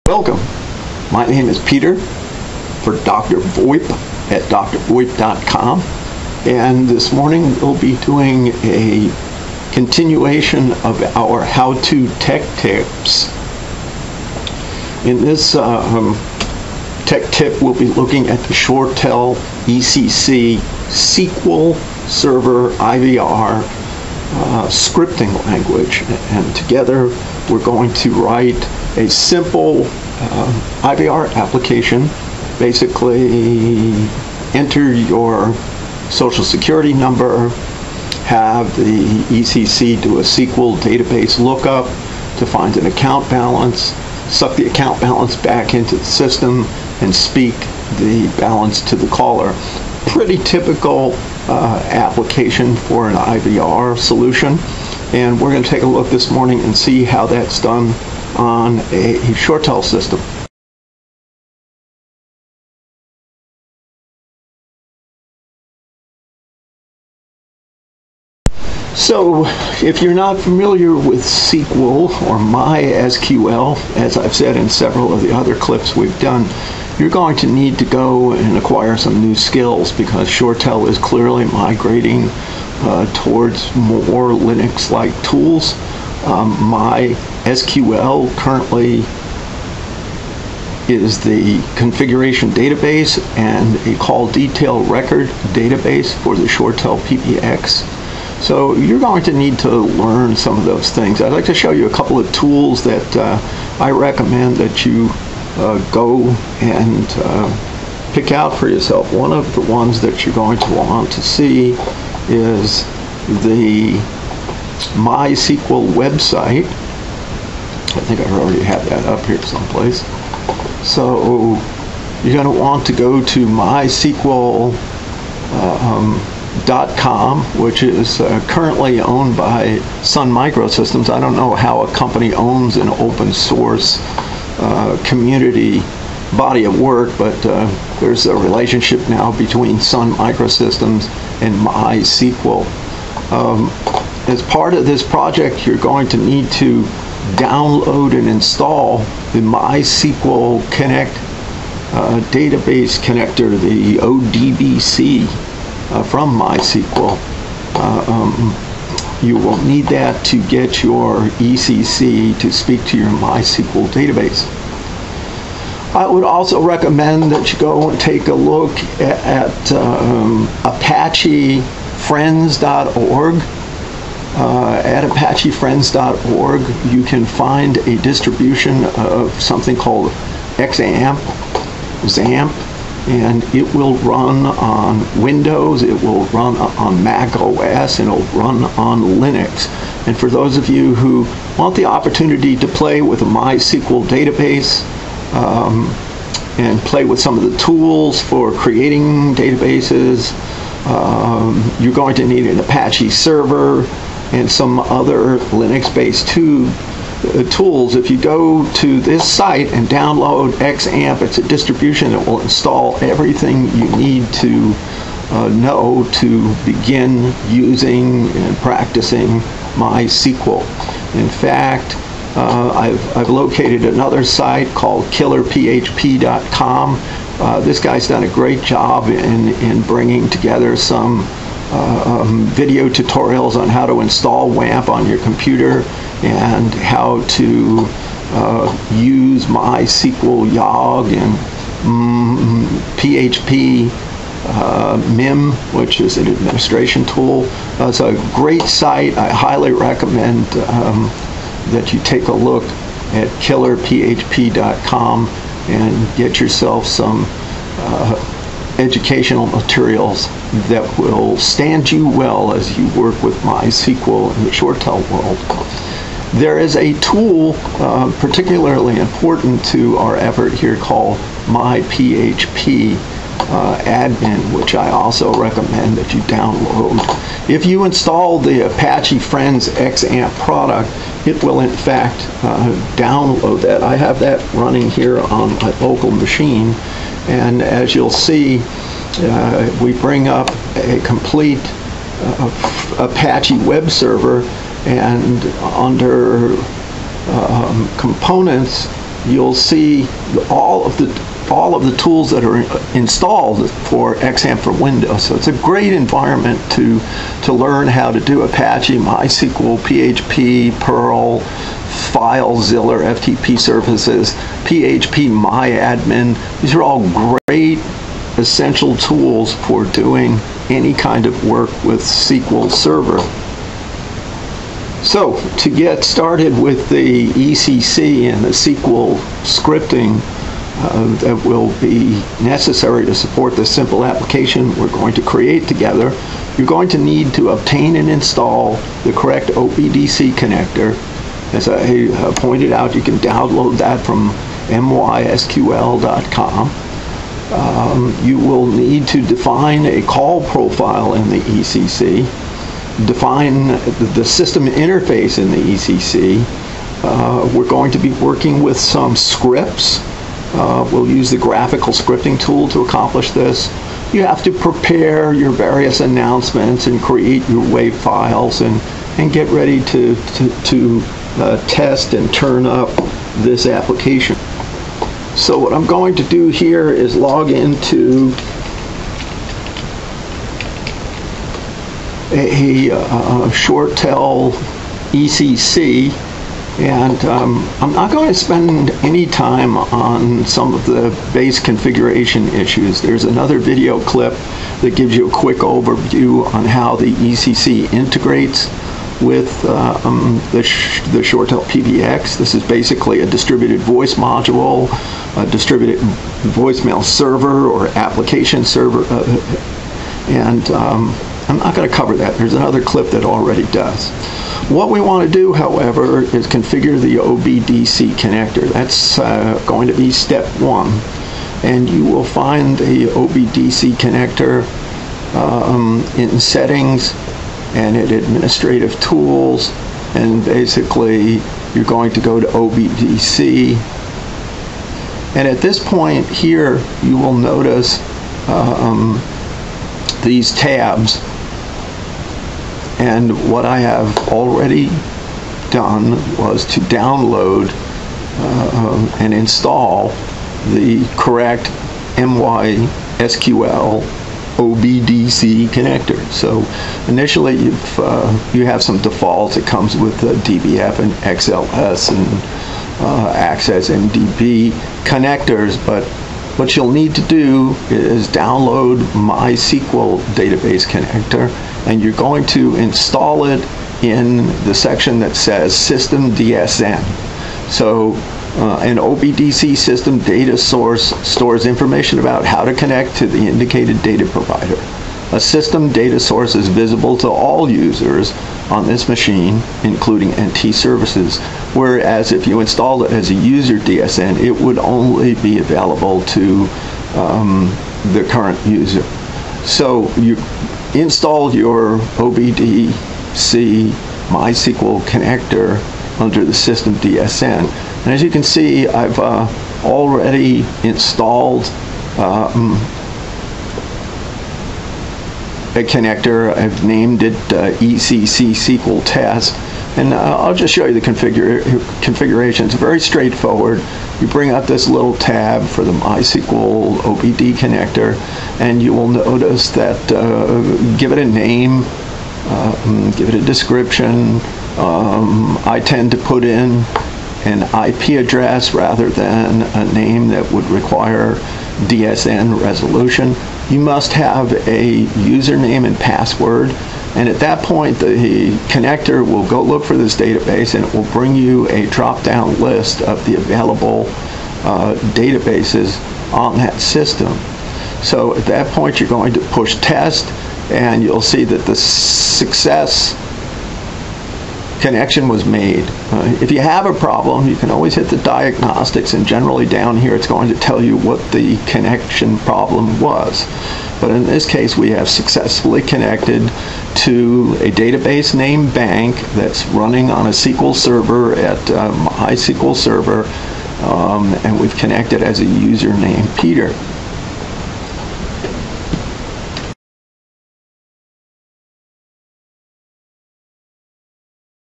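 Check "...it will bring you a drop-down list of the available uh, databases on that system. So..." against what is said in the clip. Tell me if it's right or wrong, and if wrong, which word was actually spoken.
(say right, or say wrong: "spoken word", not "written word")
right.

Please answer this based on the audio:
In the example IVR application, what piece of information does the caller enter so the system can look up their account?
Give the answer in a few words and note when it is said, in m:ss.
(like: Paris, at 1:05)
Social security number, at 0:36.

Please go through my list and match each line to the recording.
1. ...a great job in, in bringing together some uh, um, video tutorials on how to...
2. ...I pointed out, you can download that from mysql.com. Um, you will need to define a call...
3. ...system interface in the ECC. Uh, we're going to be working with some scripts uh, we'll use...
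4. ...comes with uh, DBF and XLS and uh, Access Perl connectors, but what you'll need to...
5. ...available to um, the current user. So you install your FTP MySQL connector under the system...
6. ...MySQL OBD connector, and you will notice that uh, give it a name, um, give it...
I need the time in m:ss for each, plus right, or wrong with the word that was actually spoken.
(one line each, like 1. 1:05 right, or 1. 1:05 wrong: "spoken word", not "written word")
1. 3:48 right
2. 5:41 right
3. 5:54 right
4. 7:39 wrong: "MDB", not "Perl"
5. 8:15 wrong: "OBDC", not "FTP"
6. 8:45 right.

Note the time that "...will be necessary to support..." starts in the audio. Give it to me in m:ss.
5:31.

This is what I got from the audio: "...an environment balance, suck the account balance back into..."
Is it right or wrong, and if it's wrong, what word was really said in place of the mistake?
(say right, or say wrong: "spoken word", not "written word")
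wrong: "account", not "environment".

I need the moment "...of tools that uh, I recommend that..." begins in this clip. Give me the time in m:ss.
1:42.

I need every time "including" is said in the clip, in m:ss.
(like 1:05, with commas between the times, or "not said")
8:09.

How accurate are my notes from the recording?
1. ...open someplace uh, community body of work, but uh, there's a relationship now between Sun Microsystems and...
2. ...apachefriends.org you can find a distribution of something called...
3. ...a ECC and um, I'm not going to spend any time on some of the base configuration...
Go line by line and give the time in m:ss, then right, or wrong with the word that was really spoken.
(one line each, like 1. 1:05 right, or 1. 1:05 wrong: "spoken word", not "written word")
1. 2:12 wrong: "source", not "someplace"
2. 2:55 right
3. 6:22 right.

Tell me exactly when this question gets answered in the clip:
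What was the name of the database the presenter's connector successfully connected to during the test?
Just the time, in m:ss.
9:38.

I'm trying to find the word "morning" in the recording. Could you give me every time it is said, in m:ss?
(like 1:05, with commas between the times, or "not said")
0:07, 0:56.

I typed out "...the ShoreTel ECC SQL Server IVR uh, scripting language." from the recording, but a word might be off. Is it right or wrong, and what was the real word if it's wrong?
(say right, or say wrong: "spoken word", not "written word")
right.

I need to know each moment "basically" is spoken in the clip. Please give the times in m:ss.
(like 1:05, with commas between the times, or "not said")
0:32, 6:42, 7:10.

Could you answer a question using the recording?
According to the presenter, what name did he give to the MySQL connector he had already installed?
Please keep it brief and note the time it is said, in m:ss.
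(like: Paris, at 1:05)
ECC SQL Test, at 8:37.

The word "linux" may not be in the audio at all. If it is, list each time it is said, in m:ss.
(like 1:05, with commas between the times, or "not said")
1:24, 3:09, 3:25.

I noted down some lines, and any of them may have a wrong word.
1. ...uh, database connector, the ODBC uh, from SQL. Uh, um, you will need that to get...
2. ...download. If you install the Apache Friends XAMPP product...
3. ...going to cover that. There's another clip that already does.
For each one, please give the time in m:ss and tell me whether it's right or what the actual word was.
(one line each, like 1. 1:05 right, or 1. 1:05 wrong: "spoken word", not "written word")
1. 2:31 wrong: "MySQL", not "SQL"
2. 4:36 right
3. 6:51 right.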